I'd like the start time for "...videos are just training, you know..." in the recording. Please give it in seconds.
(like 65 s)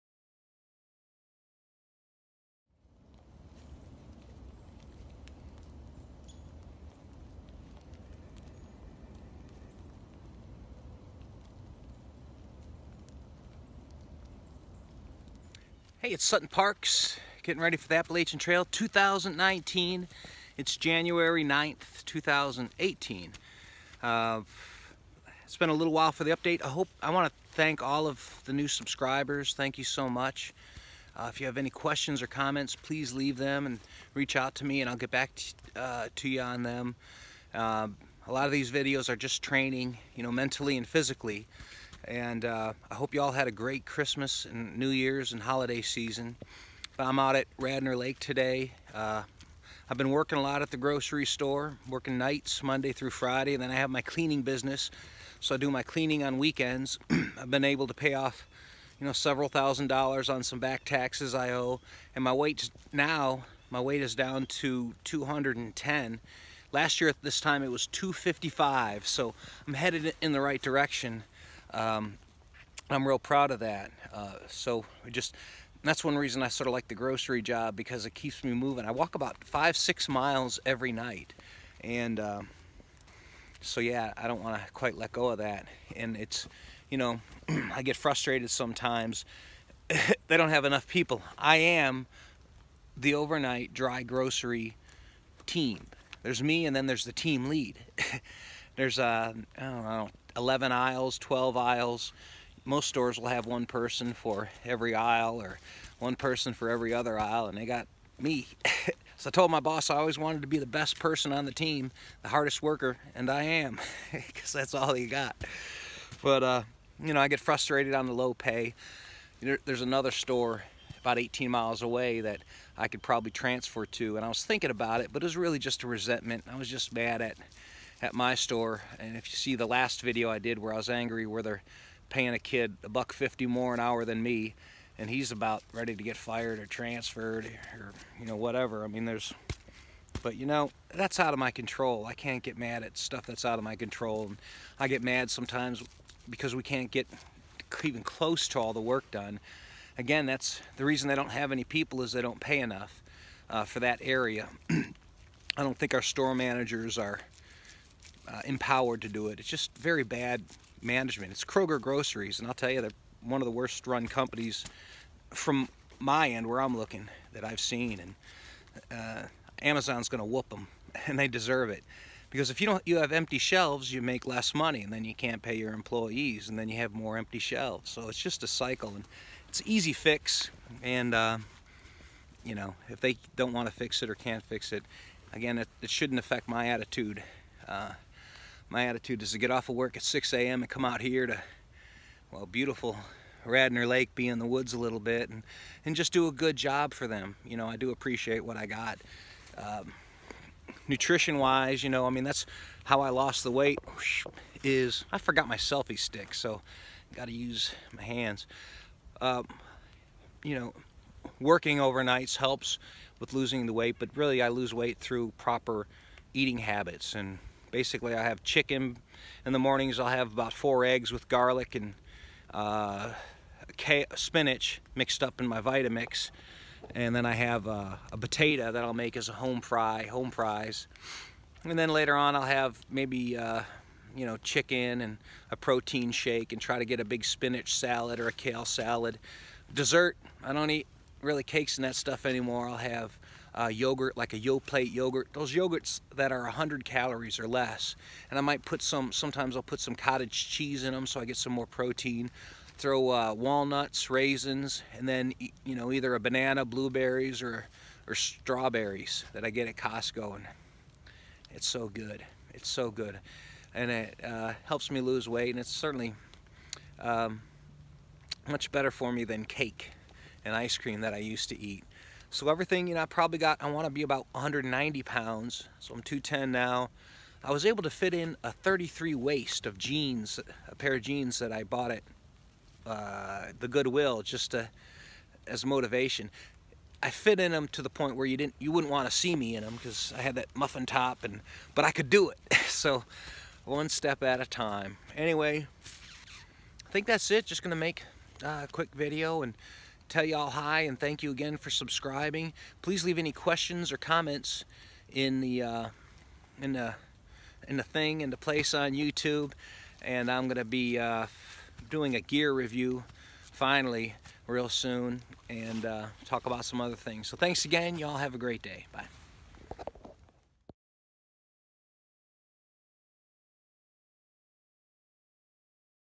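38 s.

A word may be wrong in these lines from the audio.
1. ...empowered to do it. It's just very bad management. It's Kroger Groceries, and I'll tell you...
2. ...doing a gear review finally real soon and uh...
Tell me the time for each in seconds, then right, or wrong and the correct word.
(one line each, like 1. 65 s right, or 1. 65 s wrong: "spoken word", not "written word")
1. 158 s right
2. 311 s right.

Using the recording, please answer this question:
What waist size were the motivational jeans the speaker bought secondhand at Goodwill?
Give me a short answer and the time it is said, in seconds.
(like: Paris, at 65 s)
33, at 278 s.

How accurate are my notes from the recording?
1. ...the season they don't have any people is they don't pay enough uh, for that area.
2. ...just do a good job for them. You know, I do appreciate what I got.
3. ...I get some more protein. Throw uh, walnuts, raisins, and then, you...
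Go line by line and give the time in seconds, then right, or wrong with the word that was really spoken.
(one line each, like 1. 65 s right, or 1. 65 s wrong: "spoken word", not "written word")
1. 150 s wrong: "reason", not "season"
2. 195 s right
3. 251 s right.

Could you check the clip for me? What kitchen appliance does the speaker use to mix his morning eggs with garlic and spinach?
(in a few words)
Vitamix.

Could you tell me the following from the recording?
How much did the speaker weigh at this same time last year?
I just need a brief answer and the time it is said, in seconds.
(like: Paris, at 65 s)
255, at 67 s.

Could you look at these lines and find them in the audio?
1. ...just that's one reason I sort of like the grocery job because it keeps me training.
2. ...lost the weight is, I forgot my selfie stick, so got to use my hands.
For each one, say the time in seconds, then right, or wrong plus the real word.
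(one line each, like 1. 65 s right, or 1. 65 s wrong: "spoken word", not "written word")
1. 75 s wrong: "moving", not "training"
2. 203 s right.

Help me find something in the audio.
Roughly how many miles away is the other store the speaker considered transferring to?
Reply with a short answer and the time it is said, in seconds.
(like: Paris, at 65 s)
18, at 121 s.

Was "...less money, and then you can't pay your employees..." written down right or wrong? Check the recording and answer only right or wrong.
right.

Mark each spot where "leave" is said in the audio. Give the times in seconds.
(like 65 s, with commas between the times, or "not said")
33 s, 303 s.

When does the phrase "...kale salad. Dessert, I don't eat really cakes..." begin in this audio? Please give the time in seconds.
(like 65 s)
238 s.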